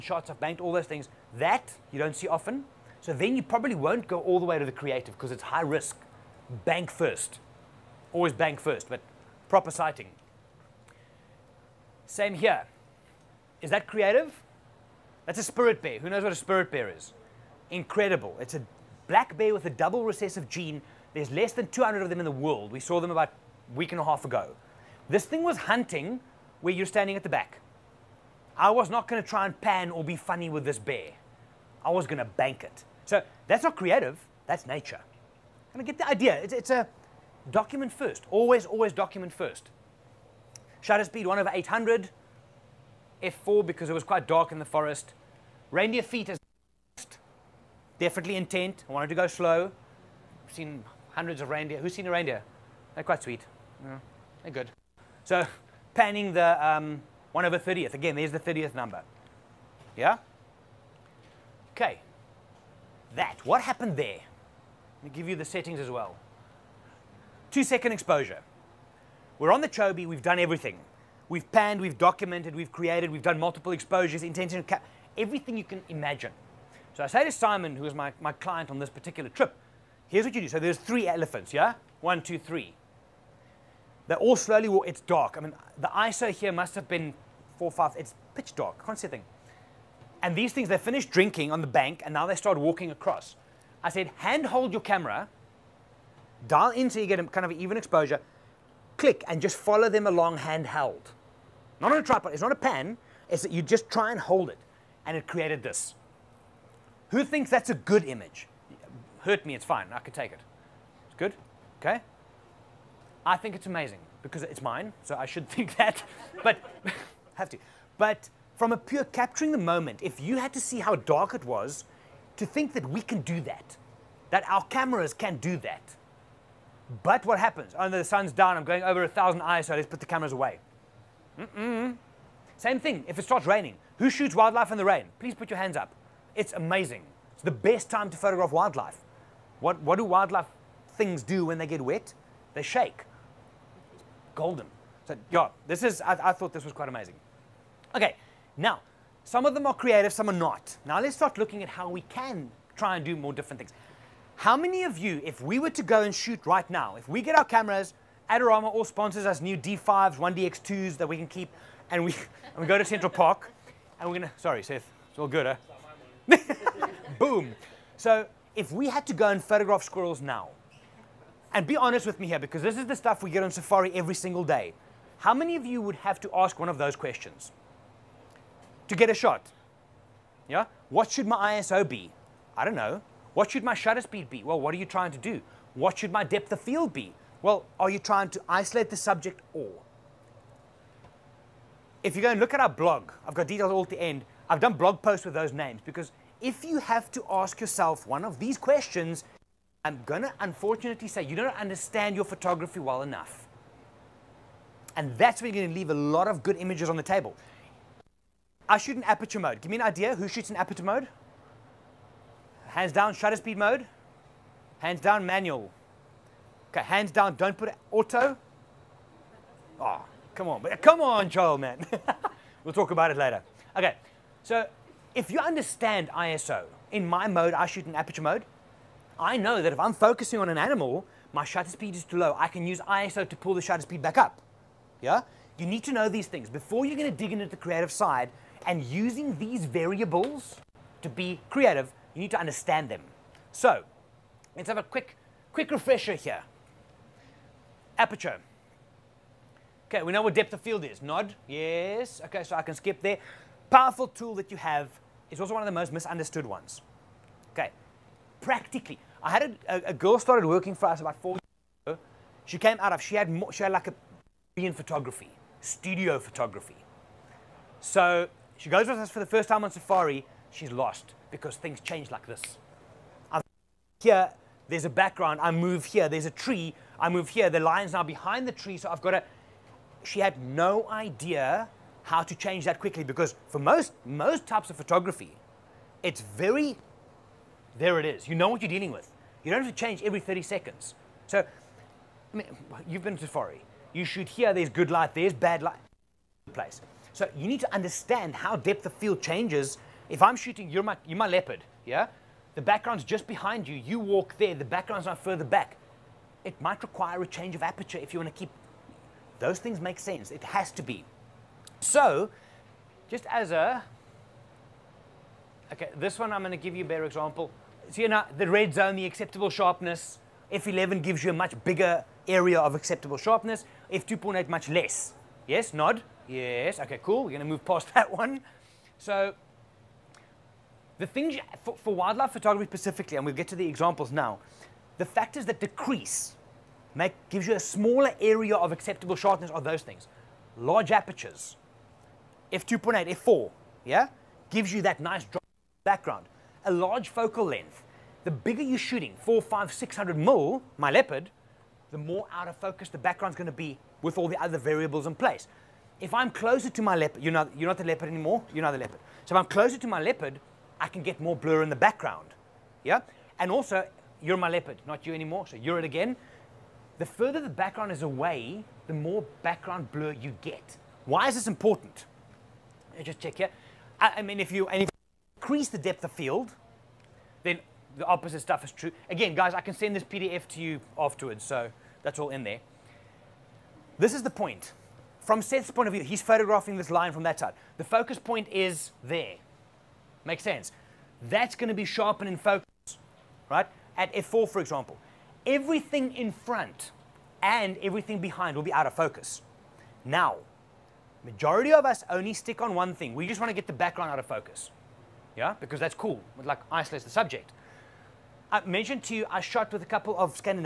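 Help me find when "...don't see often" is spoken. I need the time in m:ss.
0:01.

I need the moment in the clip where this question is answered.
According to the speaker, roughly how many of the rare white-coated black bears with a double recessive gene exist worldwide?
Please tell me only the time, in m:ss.
0:21.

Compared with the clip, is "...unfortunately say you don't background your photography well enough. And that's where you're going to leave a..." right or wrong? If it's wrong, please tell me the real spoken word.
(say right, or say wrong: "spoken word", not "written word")
wrong: "understand", not "background".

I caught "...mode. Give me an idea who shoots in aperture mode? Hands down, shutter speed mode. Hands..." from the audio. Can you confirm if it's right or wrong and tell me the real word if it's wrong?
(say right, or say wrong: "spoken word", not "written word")
right.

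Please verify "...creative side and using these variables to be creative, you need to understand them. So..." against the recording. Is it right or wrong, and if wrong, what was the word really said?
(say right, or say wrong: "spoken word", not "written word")
right.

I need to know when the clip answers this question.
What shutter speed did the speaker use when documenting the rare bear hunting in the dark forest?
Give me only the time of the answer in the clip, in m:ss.
0:41.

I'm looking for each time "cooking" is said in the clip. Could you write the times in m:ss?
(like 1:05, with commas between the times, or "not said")
not said.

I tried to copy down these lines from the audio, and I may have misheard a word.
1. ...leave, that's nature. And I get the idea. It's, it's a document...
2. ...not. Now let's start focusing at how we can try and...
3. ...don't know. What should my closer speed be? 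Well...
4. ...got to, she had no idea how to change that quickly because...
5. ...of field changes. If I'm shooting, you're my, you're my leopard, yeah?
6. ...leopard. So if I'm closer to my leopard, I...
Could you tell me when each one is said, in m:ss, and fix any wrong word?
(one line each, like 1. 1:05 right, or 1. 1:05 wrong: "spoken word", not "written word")
1. 0:33 wrong: "creative", not "leave"
2. 2:30 wrong: "looking", not "focusing"
3. 3:02 wrong: "shutter", not "closer"
4. 4:39 right
5. 4:58 right
6. 5:58 right.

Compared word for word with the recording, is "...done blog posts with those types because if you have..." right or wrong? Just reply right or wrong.
wrong.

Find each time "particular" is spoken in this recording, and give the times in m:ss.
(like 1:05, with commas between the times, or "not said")
1:18.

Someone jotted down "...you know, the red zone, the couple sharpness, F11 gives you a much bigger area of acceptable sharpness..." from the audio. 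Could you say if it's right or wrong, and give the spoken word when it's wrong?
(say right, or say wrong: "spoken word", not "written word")
wrong: "acceptable", not "couple".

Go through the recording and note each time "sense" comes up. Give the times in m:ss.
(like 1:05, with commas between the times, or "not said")
5:09, 6:30.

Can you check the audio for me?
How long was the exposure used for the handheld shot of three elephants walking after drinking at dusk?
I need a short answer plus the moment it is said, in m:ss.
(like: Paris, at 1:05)
2 seconds, at 1:07.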